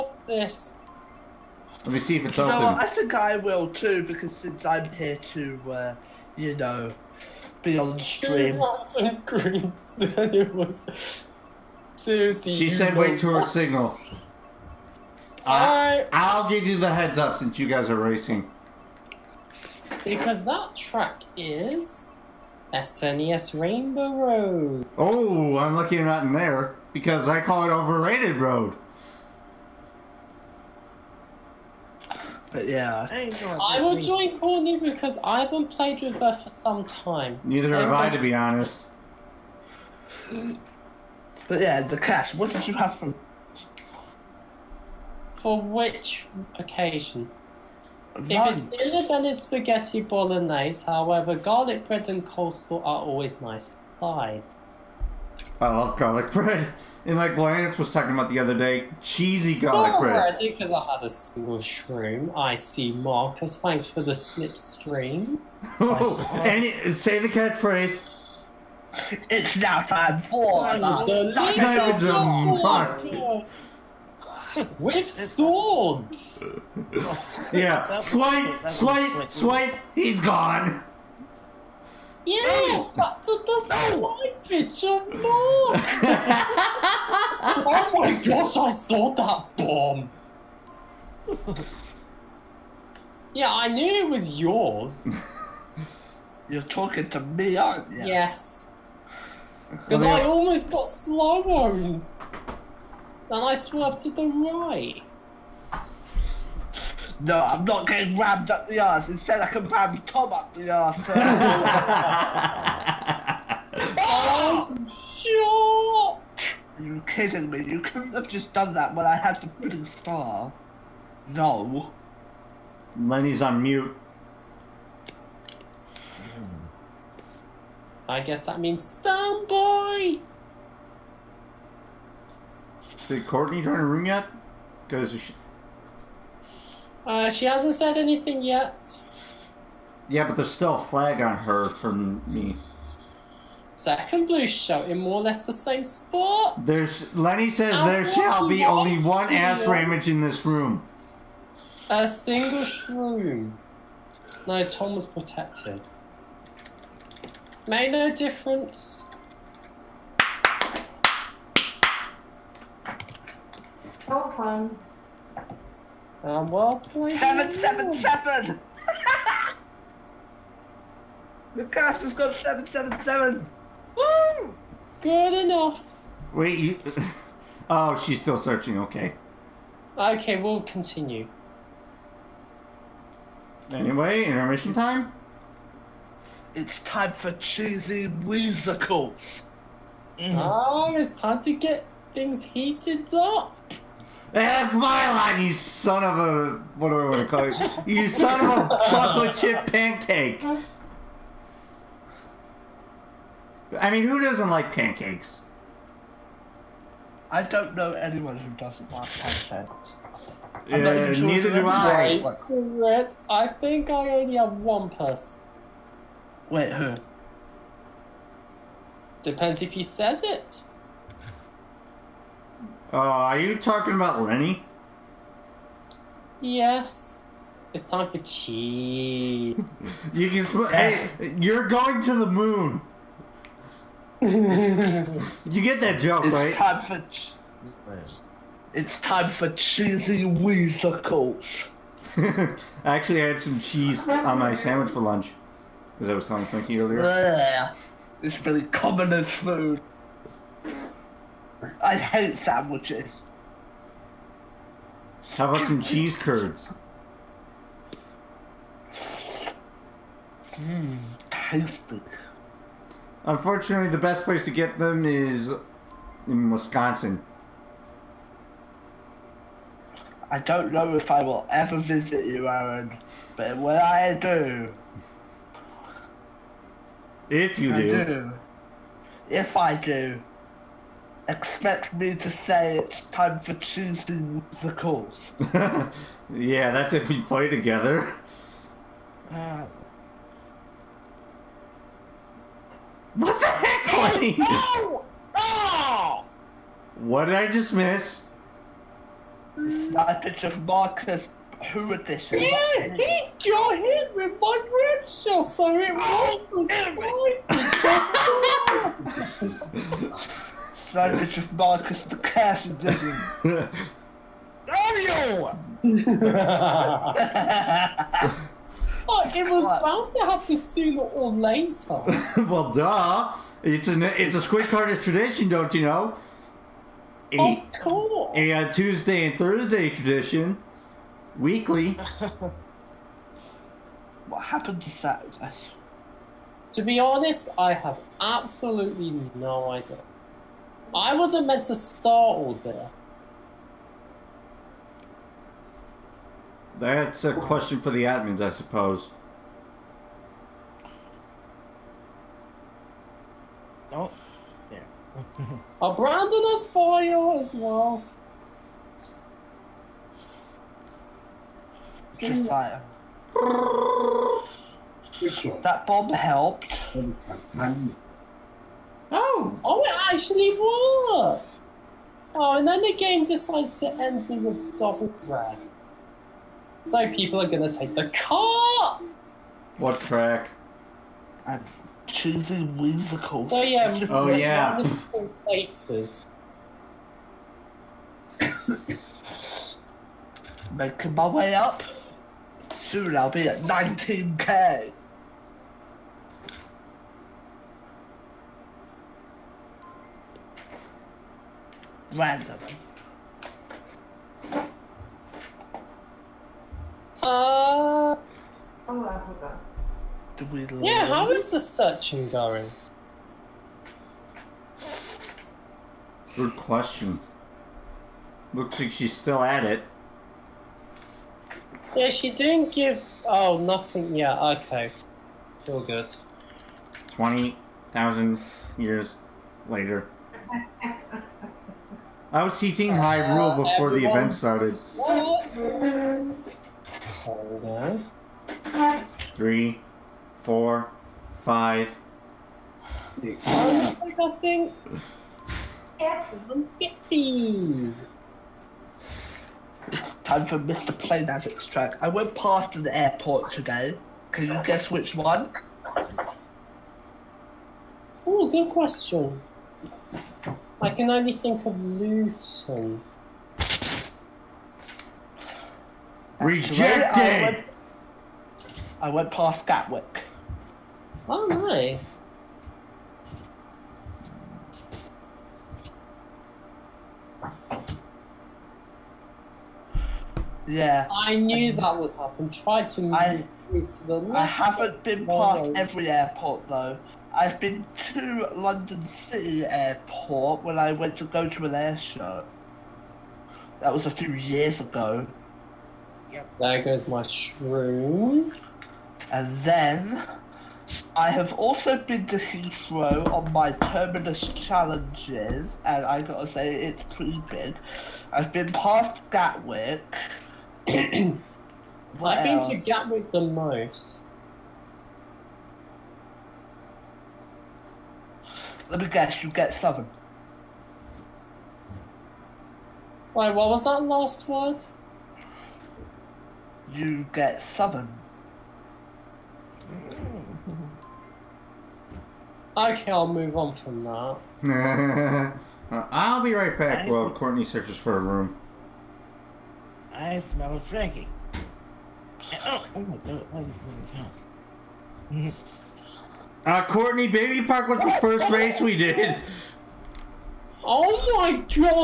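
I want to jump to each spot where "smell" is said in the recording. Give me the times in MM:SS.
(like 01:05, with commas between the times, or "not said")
03:50, 09:00.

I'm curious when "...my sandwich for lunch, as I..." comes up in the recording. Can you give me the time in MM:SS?
04:04.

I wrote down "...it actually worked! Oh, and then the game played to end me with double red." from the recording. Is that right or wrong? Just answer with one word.
wrong.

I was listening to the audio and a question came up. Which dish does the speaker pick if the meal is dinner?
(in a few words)
Spaghetti bolognese.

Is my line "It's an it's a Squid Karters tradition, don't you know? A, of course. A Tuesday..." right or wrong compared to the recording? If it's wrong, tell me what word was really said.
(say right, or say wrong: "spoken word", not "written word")
right.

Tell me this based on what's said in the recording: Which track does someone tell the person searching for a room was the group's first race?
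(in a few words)
Baby Park.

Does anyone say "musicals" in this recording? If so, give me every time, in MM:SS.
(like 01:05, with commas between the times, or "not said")
03:08, 04:44, 06:22.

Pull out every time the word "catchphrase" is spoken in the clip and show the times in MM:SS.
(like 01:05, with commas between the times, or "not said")
01:07.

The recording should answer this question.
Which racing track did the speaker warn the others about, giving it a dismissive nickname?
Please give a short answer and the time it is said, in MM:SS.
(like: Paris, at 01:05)
SNES Rainbow Road, at 00:22.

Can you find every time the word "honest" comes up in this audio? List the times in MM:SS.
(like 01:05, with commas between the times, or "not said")
00:38, 05:36.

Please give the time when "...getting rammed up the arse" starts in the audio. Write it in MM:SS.
01:47.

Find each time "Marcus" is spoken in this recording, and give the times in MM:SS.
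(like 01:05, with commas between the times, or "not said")
01:02, 01:12, 05:00.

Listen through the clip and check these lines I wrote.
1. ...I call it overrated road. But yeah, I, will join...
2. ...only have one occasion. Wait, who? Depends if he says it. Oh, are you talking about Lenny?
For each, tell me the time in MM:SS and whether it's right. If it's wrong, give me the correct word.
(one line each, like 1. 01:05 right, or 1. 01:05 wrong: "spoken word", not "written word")
1. 00:27 right
2. 03:34 wrong: "person", not "occasion".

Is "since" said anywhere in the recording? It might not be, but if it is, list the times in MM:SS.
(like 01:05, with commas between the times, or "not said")
00:04, 00:17.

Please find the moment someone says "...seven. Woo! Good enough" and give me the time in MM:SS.
02:53.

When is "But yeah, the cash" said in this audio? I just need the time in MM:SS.
00:41.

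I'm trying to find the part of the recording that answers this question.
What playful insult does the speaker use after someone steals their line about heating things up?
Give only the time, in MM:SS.
03:18.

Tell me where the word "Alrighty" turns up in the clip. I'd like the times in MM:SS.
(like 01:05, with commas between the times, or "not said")
00:59.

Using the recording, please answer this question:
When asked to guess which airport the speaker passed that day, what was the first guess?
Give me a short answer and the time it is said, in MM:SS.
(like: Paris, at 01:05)
Luton, at 07:41.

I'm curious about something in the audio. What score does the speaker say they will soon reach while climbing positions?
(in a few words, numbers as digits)
19k.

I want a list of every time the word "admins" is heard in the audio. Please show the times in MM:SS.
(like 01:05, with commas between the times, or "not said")
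05:48.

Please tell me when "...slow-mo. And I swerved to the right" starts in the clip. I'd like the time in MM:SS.
01:40.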